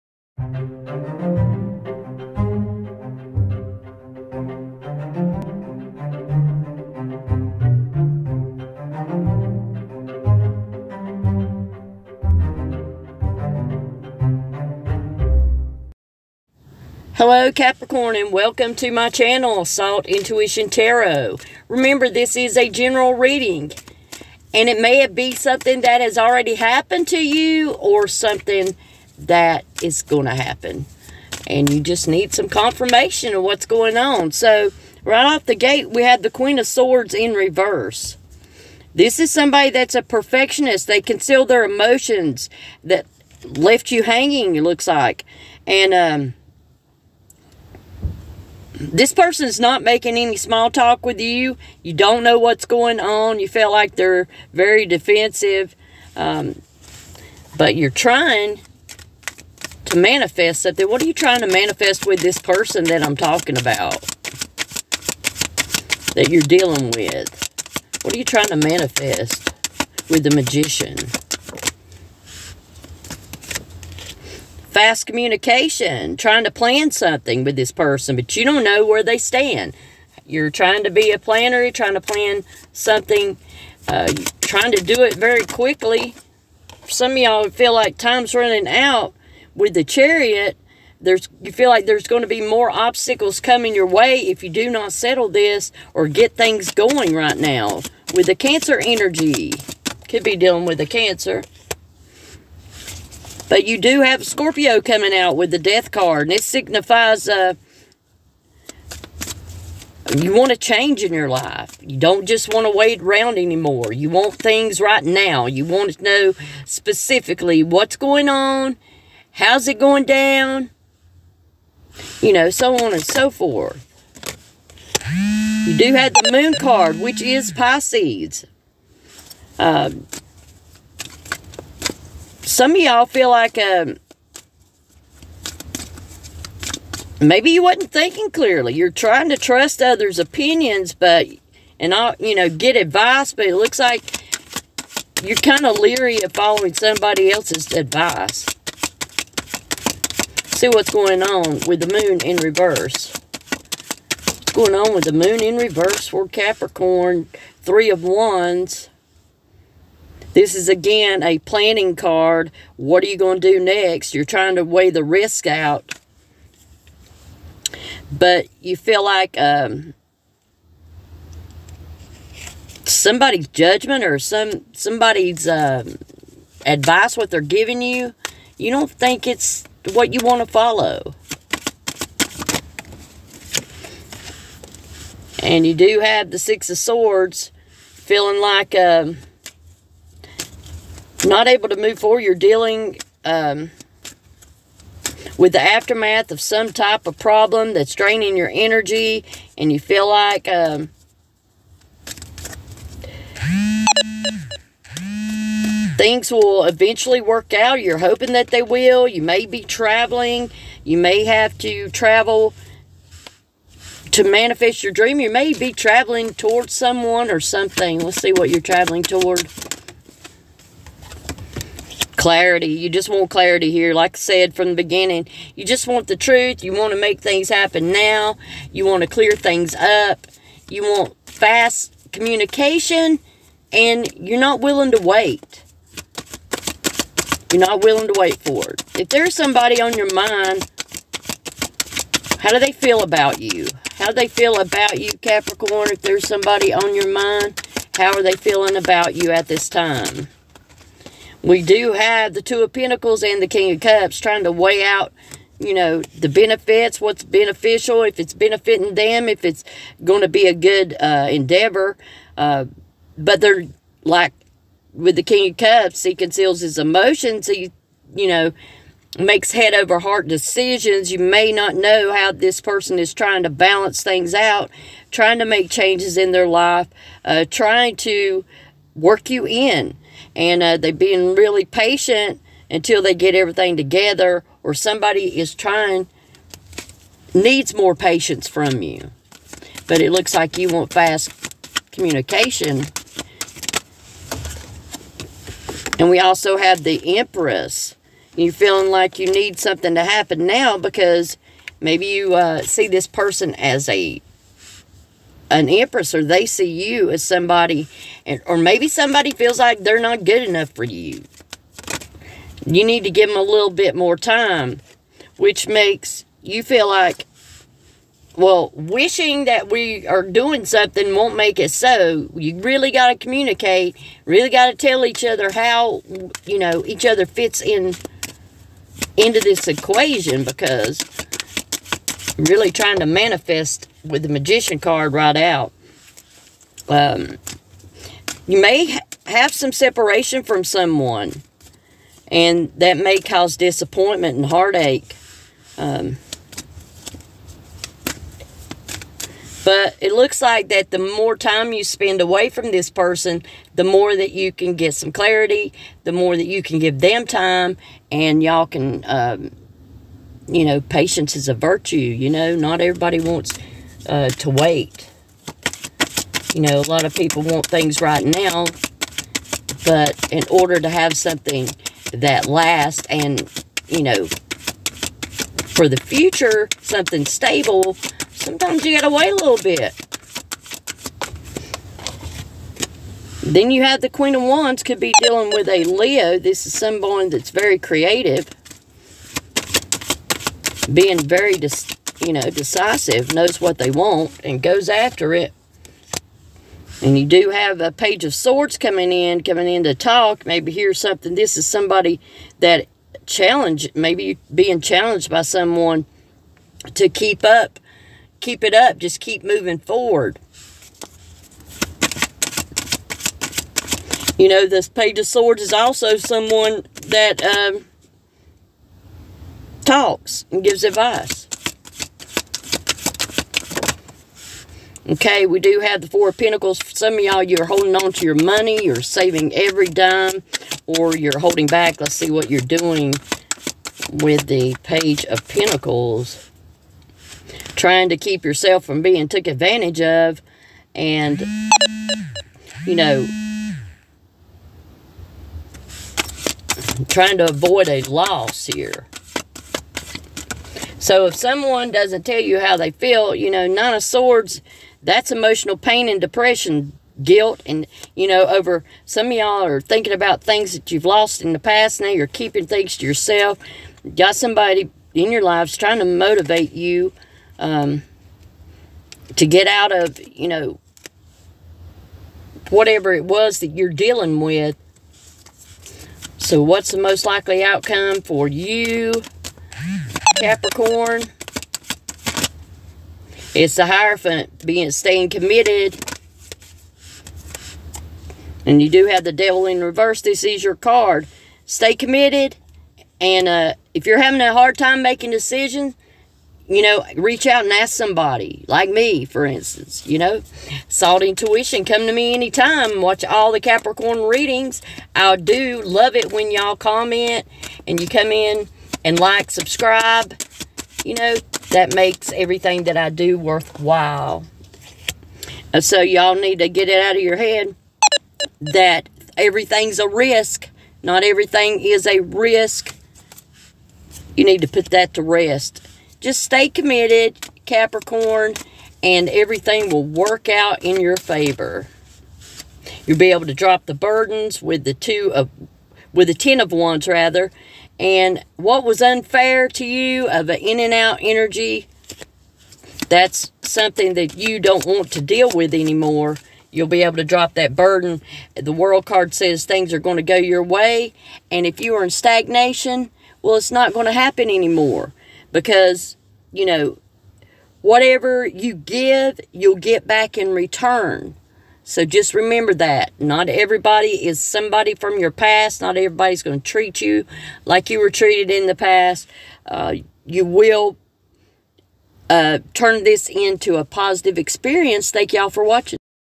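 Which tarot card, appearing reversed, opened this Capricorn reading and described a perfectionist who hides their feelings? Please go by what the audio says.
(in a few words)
Queen of Swords.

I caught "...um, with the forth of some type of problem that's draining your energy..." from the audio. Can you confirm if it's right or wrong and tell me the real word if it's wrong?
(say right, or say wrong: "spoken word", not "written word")
wrong: "aftermath", not "forth".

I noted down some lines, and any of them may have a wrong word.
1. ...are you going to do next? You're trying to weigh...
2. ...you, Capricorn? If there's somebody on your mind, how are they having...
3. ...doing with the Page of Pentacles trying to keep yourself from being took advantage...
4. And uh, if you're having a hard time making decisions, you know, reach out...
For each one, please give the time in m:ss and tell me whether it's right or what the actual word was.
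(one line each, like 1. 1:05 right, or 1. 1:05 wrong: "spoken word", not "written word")
1. 2:43 right
2. 4:04 wrong: "feeling", not "having"
3. 7:12 right
4. 8:13 right.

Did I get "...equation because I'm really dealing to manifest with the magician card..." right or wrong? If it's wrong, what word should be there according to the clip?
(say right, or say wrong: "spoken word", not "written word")
wrong: "trying", not "dealing".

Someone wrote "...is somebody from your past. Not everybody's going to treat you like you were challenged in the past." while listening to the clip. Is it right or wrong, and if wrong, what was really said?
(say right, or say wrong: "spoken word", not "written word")
wrong: "treated", not "challenged".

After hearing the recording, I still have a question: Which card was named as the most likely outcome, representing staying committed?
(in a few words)
The Hierophant.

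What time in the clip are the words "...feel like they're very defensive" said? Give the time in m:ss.
0:53.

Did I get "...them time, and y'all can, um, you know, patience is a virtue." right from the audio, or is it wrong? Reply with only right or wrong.
right.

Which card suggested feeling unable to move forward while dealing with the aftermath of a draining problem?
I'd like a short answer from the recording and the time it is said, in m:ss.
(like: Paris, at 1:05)
Six of Swords, at 3:06.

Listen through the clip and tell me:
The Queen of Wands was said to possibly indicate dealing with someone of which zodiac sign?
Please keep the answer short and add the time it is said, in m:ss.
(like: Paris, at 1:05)
Leo, at 6:25.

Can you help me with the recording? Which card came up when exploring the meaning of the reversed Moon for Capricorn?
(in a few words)
Three of Wands.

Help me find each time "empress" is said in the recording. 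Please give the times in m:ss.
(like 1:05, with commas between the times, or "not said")
4:57, 5:05.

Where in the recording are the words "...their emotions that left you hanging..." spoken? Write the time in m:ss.
0:41.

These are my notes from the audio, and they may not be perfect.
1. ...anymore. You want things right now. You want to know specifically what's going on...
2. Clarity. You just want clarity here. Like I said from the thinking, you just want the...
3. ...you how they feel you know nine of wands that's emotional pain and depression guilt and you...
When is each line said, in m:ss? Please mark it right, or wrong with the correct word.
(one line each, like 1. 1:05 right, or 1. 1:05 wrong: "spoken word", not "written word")
1. 1:53 right
2. 3:42 wrong: "beginning", not "thinking"
3. 7:32 wrong: "swords", not "wands".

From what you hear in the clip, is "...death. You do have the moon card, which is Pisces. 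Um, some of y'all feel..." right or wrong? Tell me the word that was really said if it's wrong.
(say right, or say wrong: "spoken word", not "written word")
wrong: "forth", not "death".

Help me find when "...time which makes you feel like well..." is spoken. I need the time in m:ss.
5:14.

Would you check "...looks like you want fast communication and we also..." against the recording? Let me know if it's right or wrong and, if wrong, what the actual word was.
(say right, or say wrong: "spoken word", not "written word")
right.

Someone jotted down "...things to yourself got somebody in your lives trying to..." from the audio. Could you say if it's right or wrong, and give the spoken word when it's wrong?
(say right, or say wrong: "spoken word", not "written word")
right.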